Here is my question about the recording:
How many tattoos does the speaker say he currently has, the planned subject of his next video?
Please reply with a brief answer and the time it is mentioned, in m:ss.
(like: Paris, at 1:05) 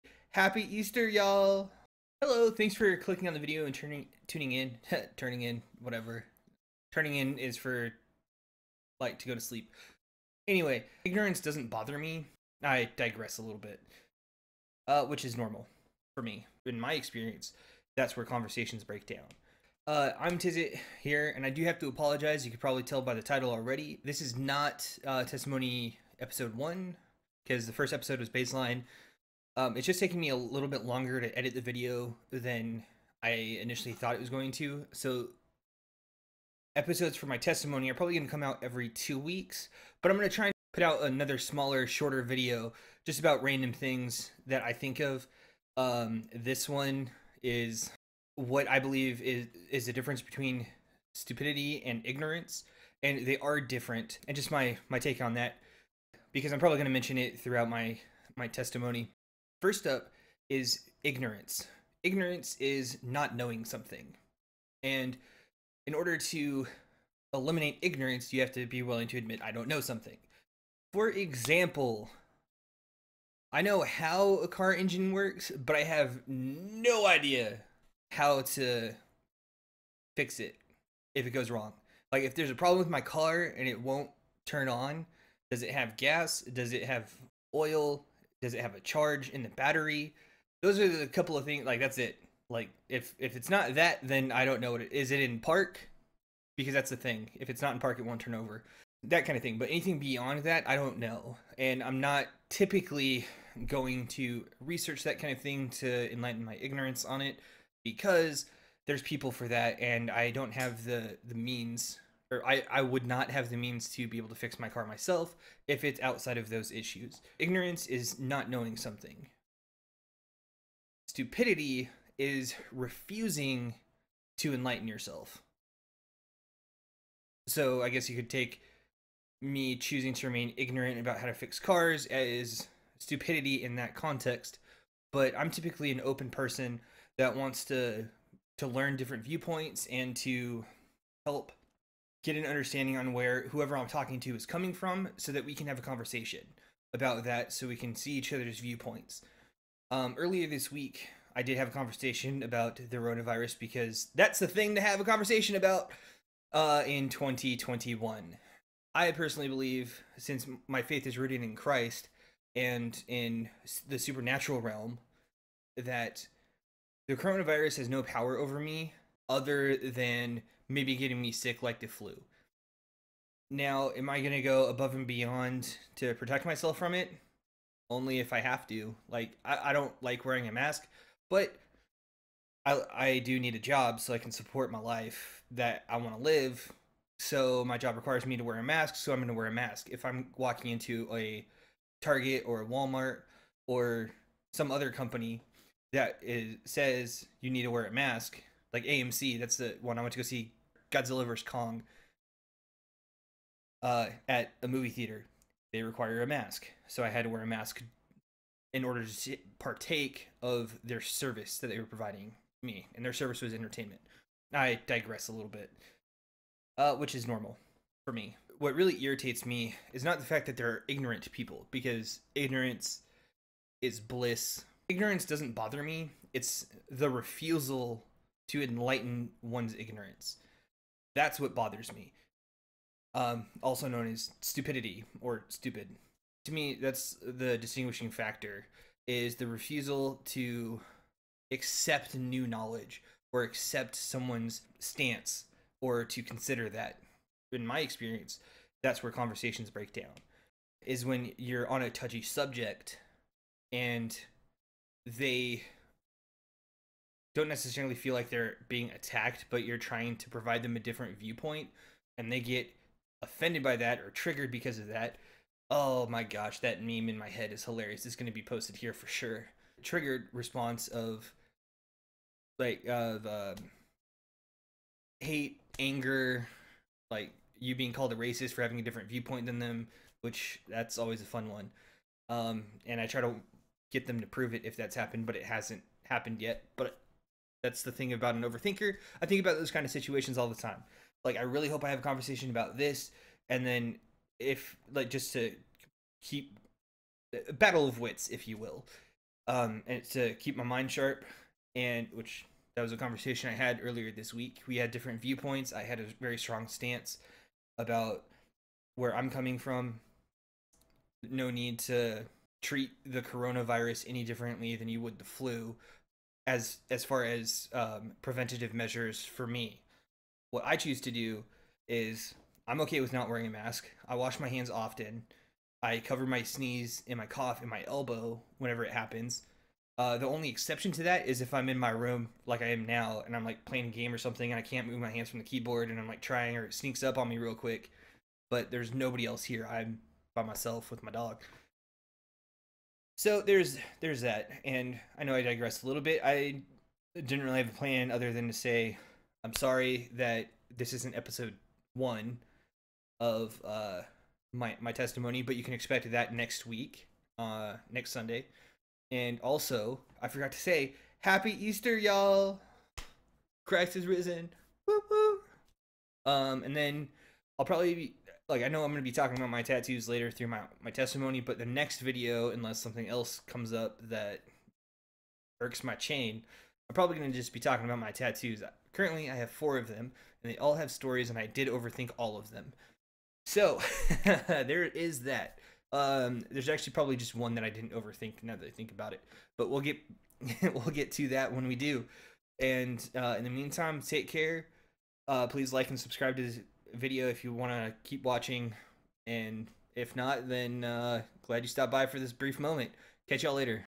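4, at 6:19.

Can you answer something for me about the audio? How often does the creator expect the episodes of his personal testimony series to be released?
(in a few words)
every two weeks.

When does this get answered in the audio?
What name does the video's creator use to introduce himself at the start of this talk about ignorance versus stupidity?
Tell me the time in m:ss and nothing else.
0:20.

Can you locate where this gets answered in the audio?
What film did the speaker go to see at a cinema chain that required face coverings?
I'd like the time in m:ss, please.
3:20.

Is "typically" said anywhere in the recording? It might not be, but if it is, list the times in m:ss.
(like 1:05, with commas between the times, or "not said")
1:42, 2:15.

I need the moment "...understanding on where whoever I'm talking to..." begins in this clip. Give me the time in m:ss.
2:22.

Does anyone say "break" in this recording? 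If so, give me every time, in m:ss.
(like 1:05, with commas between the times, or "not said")
0:18, 4:09.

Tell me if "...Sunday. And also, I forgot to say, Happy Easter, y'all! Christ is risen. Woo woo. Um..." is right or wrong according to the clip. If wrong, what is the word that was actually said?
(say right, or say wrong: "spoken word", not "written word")
right.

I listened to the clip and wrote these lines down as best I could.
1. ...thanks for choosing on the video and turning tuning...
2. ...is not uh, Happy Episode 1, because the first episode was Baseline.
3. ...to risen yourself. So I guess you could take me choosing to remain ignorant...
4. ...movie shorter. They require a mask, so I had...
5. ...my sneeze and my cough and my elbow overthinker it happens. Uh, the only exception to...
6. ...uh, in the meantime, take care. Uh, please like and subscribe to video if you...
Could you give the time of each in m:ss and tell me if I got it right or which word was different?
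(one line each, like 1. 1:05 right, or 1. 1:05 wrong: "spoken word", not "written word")
1. 0:02 wrong: "clicking", not "choosing"
2. 0:24 wrong: "Testimony", not "Happy"
3. 2:04 wrong: "enlighten", not "risen"
4. 3:24 wrong: "theater", not "shorter"
5. 5:26 wrong: "whenever", not "overthinker"
6. 6:33 right.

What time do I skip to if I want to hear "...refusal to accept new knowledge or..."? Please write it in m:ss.
3:59.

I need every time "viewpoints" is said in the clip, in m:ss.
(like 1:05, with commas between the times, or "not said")
2:19, 2:28, 4:21, 4:39, 5:05.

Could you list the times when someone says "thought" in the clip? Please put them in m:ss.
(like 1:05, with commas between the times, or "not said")
0:33.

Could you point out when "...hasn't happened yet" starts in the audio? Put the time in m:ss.
4:45.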